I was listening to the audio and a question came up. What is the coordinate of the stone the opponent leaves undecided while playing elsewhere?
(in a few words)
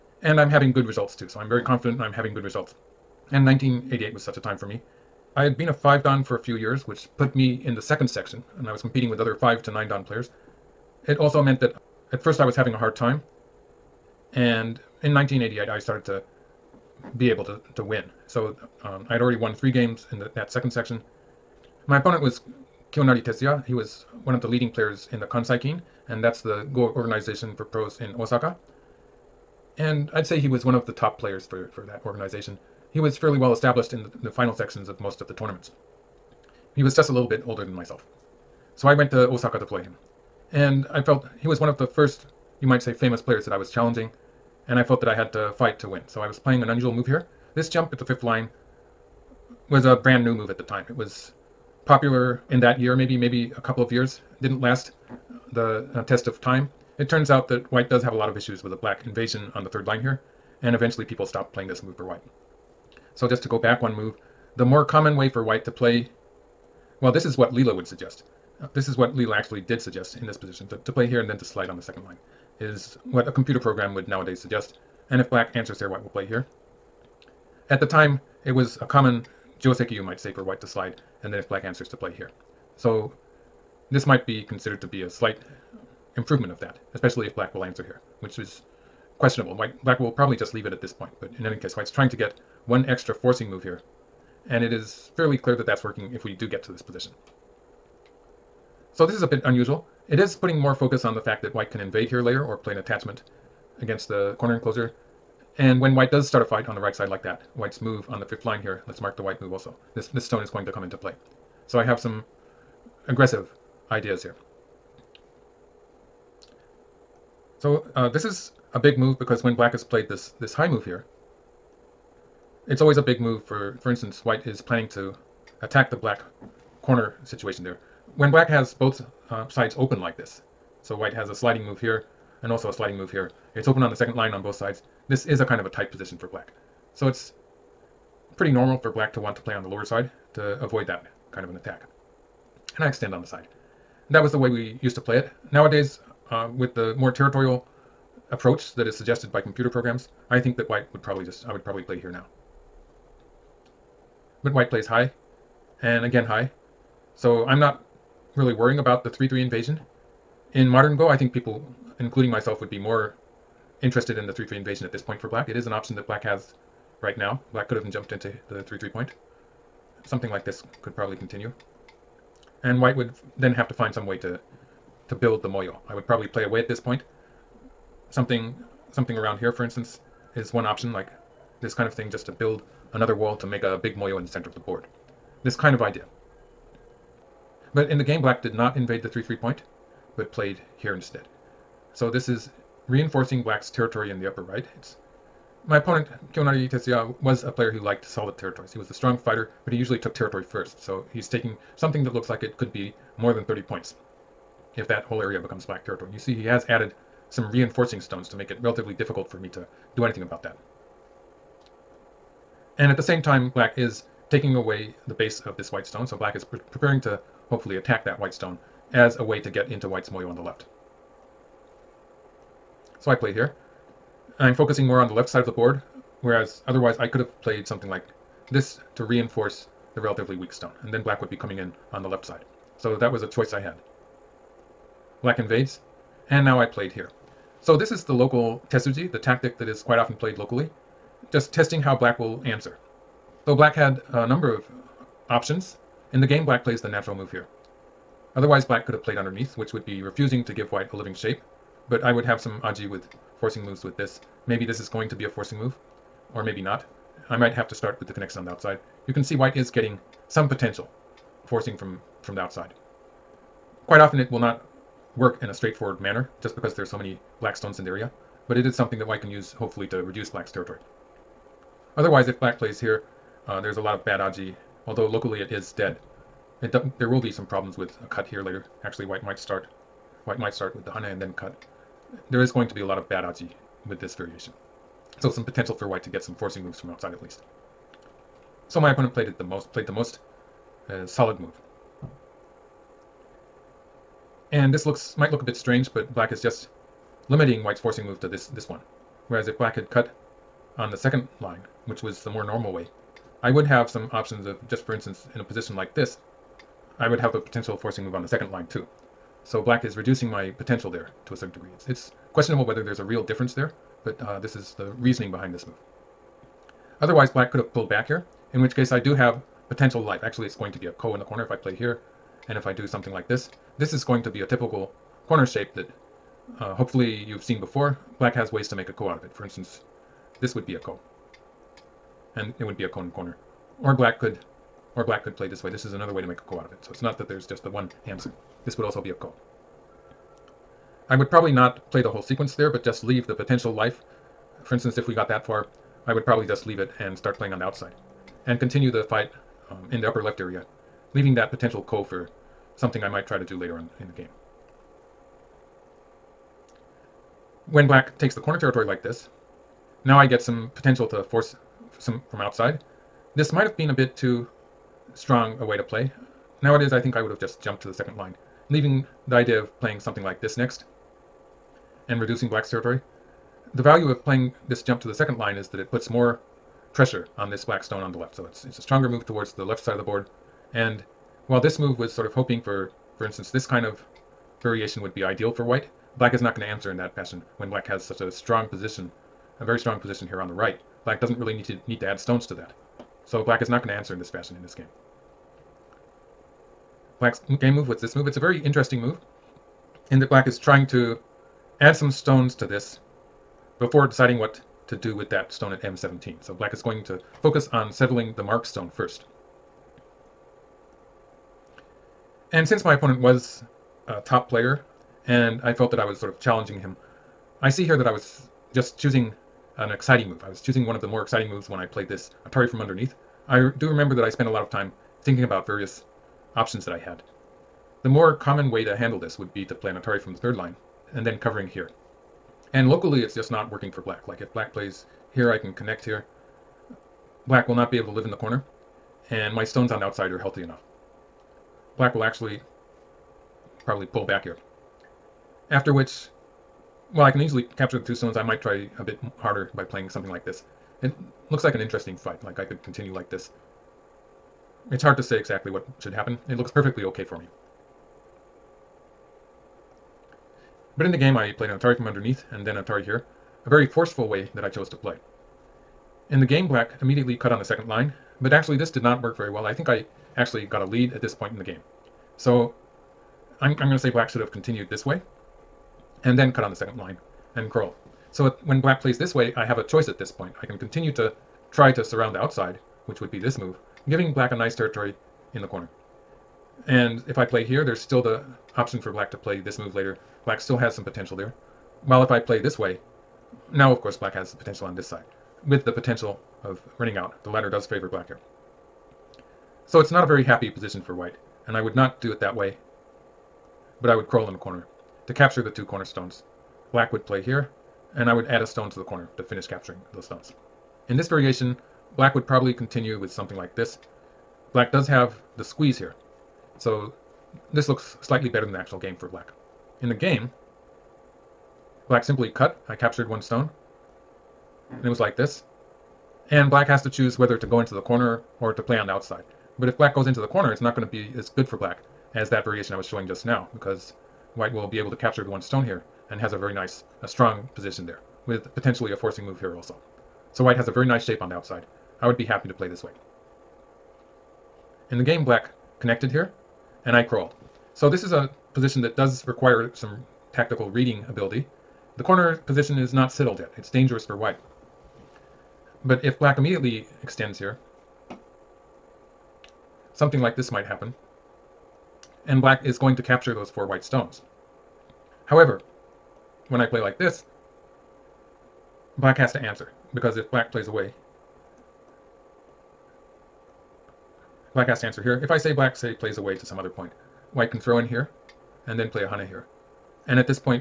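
M17.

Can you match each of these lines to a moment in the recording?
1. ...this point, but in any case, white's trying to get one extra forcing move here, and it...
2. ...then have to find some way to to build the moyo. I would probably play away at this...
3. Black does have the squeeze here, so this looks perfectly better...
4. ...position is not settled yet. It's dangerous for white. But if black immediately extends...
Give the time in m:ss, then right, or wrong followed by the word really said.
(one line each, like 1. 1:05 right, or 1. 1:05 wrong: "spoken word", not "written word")
1. 1:30 right
2. 2:53 right
3. 8:34 wrong: "slightly", not "perfectly"
4. 9:12 right.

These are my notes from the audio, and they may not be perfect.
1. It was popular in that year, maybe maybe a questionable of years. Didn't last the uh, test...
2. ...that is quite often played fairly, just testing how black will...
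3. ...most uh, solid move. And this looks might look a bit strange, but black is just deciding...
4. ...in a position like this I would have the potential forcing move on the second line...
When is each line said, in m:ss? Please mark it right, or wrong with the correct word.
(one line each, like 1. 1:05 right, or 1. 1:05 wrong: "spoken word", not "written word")
1. 0:50 wrong: "couple", not "questionable"
2. 3:59 wrong: "locally", not "fairly"
3. 4:49 wrong: "limiting", not "deciding"
4. 5:05 right.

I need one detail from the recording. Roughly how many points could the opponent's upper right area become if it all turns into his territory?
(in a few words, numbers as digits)
more than 30.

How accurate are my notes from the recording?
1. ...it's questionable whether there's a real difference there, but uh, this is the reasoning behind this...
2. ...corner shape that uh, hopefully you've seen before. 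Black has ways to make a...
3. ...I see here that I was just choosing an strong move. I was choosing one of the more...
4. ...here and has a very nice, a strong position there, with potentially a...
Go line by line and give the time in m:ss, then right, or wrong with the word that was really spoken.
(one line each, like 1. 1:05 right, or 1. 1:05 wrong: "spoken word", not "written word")
1. 5:11 right
2. 5:25 right
3. 6:57 wrong: "exciting", not "strong"
4. 8:55 right.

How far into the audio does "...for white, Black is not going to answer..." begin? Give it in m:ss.
6:25.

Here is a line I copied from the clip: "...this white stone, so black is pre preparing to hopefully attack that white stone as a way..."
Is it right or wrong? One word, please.
right.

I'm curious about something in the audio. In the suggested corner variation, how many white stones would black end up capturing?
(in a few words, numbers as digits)
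four.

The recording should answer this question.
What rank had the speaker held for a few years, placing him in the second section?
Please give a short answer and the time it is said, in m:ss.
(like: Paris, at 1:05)
five dan, at 0:05.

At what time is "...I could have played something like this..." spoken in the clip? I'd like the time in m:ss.
3:46.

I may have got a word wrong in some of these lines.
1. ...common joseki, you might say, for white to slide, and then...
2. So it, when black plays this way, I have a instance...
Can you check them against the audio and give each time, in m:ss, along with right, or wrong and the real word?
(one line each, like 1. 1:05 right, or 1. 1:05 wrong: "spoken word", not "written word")
1. 1:18 right
2. 7:58 wrong: "choice", not "instance".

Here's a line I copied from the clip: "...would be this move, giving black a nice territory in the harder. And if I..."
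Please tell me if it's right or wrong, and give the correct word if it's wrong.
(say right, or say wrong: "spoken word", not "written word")
wrong: "corner", not "harder".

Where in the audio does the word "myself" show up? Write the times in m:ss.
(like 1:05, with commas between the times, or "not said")
0:37, 2:42.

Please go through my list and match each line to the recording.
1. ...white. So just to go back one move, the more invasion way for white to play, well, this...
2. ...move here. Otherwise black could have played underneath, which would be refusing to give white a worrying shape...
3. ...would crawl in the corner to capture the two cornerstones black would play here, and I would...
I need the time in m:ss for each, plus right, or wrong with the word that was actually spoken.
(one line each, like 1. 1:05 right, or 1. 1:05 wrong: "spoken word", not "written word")
1. 1:02 wrong: "common", not "invasion"
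2. 4:07 wrong: "living", not "worrying"
3. 8:24 right.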